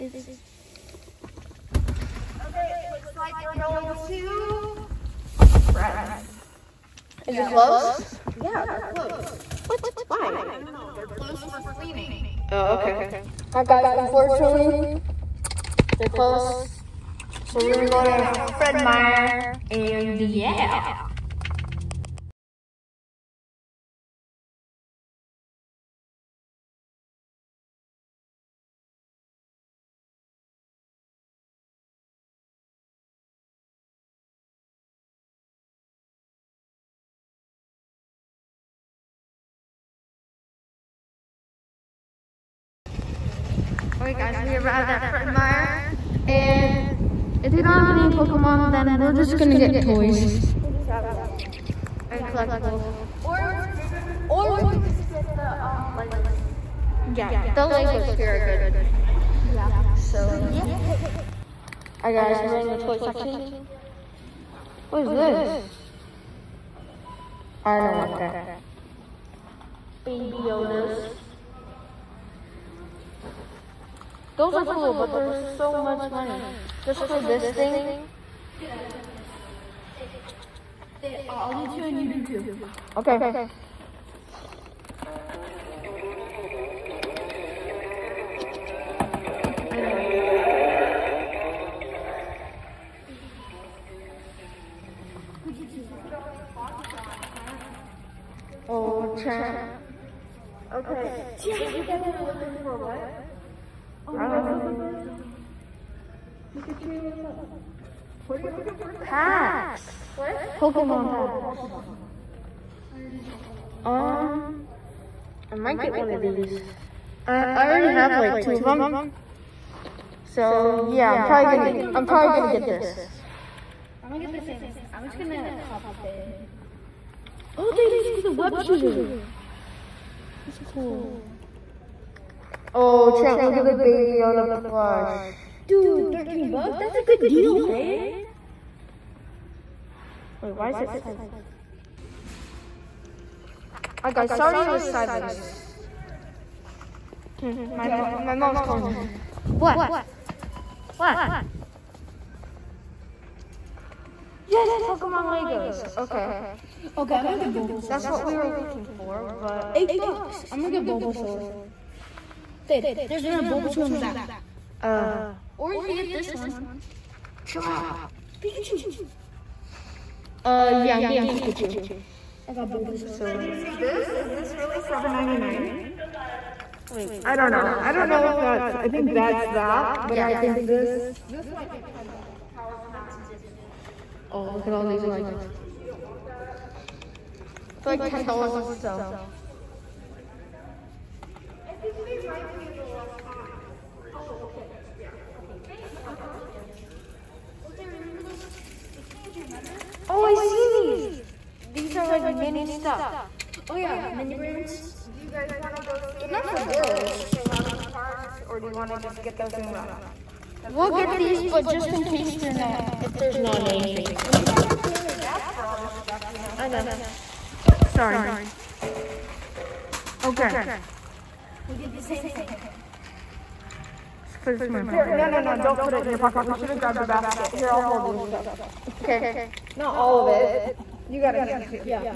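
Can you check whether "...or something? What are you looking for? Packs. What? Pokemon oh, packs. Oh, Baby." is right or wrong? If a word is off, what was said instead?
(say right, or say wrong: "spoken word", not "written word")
wrong: "Pokemon", not "Baby".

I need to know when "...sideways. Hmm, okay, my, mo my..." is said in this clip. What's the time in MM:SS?
02:24.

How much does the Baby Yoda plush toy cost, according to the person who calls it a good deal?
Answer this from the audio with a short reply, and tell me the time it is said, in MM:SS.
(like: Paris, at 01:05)
$13, at 02:16.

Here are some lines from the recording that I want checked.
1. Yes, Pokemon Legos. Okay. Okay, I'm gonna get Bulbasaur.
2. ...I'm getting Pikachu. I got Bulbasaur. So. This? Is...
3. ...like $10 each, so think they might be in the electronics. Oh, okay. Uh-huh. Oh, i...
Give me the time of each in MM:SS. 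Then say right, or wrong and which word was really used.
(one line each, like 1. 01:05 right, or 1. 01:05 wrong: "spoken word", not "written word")
1. 02:34 right
2. 02:50 right
3. 03:07 right.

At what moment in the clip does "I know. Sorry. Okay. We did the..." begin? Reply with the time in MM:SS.
03:36.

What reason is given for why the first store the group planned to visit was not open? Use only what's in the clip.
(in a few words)
Cleaning.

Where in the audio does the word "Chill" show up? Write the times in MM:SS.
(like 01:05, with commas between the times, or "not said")
02:47.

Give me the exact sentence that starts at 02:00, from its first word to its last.
So yeah, I'm probably gonna I'm probably gonna get this.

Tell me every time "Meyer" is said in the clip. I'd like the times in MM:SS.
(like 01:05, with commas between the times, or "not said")
00:18, 00:45.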